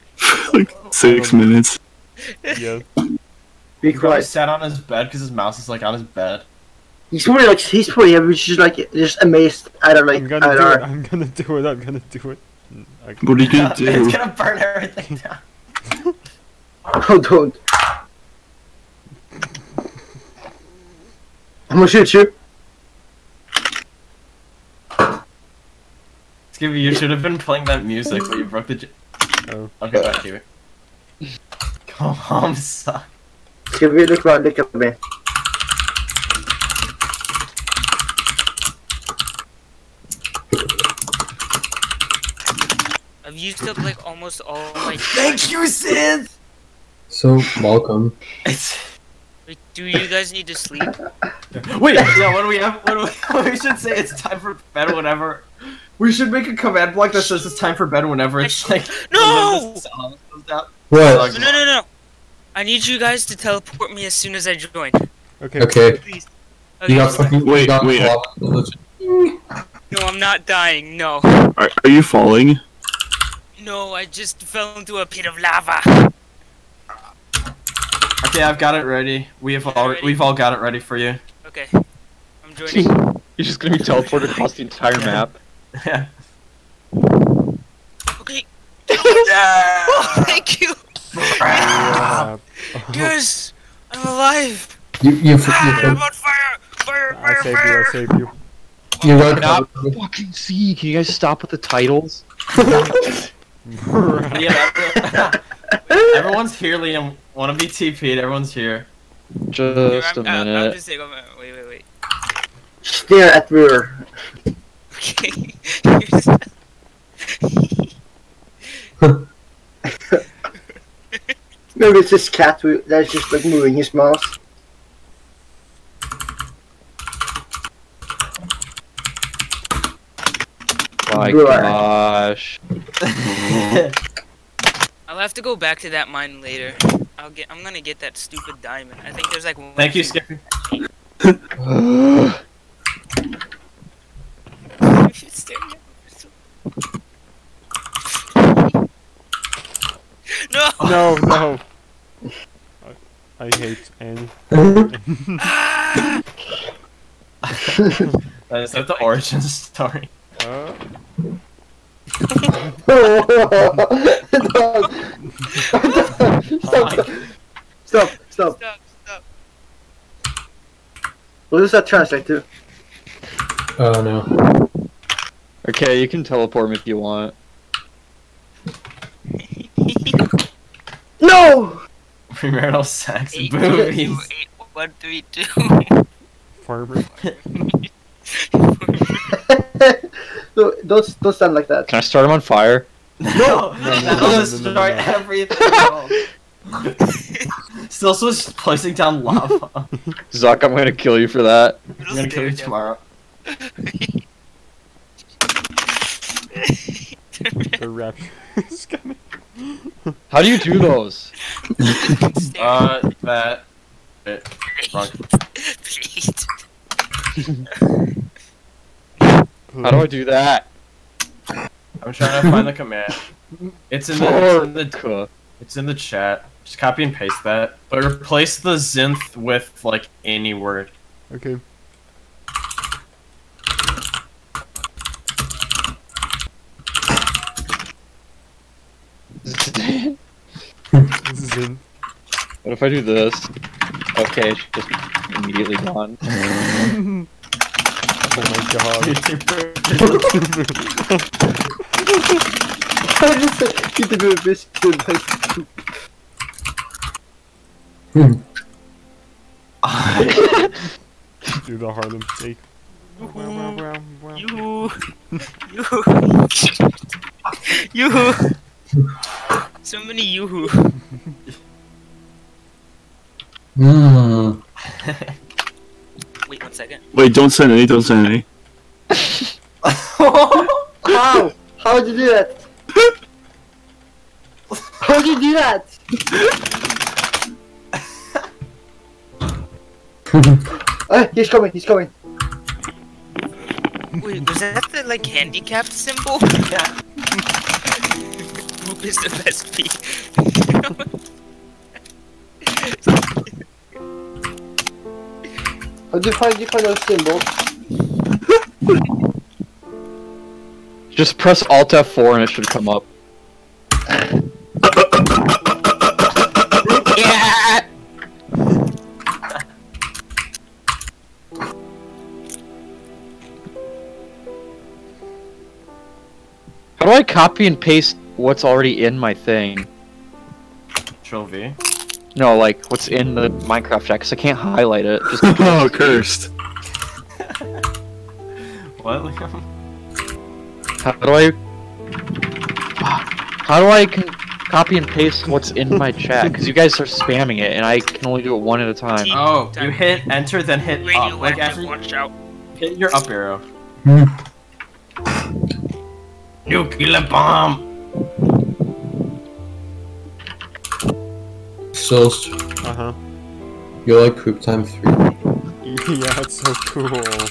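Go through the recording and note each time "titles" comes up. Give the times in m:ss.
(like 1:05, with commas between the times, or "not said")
1:41.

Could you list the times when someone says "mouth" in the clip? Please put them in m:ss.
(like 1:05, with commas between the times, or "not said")
2:03.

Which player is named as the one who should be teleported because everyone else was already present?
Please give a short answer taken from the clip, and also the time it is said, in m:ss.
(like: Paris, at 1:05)
Liam, at 1:46.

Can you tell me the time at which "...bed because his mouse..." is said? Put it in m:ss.
0:04.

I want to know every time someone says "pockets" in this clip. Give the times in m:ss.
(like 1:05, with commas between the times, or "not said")
not said.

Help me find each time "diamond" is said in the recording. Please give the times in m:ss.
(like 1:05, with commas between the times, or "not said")
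2:18.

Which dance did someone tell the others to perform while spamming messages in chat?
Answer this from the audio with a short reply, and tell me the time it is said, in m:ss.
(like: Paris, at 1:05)
The Harlem Shake, at 4:21.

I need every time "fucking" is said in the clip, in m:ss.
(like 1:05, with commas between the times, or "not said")
1:07, 1:39.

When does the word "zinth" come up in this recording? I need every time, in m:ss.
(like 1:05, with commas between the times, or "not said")
3:48, 3:59.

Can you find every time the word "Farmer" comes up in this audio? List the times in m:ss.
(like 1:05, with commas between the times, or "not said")
3:06.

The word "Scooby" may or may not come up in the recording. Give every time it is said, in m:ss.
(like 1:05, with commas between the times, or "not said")
0:26, 0:33.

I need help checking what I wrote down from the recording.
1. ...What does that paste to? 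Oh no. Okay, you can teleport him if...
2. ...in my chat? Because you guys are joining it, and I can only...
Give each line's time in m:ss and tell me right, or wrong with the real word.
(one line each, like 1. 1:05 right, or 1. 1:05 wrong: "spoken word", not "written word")
1. 2:51 wrong: "translate", not "paste"
2. 5:45 wrong: "spamming", not "joining".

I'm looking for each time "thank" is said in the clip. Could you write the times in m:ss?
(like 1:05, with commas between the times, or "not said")
0:44, 1:30, 2:19.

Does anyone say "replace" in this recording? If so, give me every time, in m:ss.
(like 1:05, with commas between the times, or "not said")
3:48.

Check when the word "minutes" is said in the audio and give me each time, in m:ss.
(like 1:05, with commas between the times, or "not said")
0:01, 1:50.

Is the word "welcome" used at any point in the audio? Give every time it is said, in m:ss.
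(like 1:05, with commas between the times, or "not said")
0:47, 1:39.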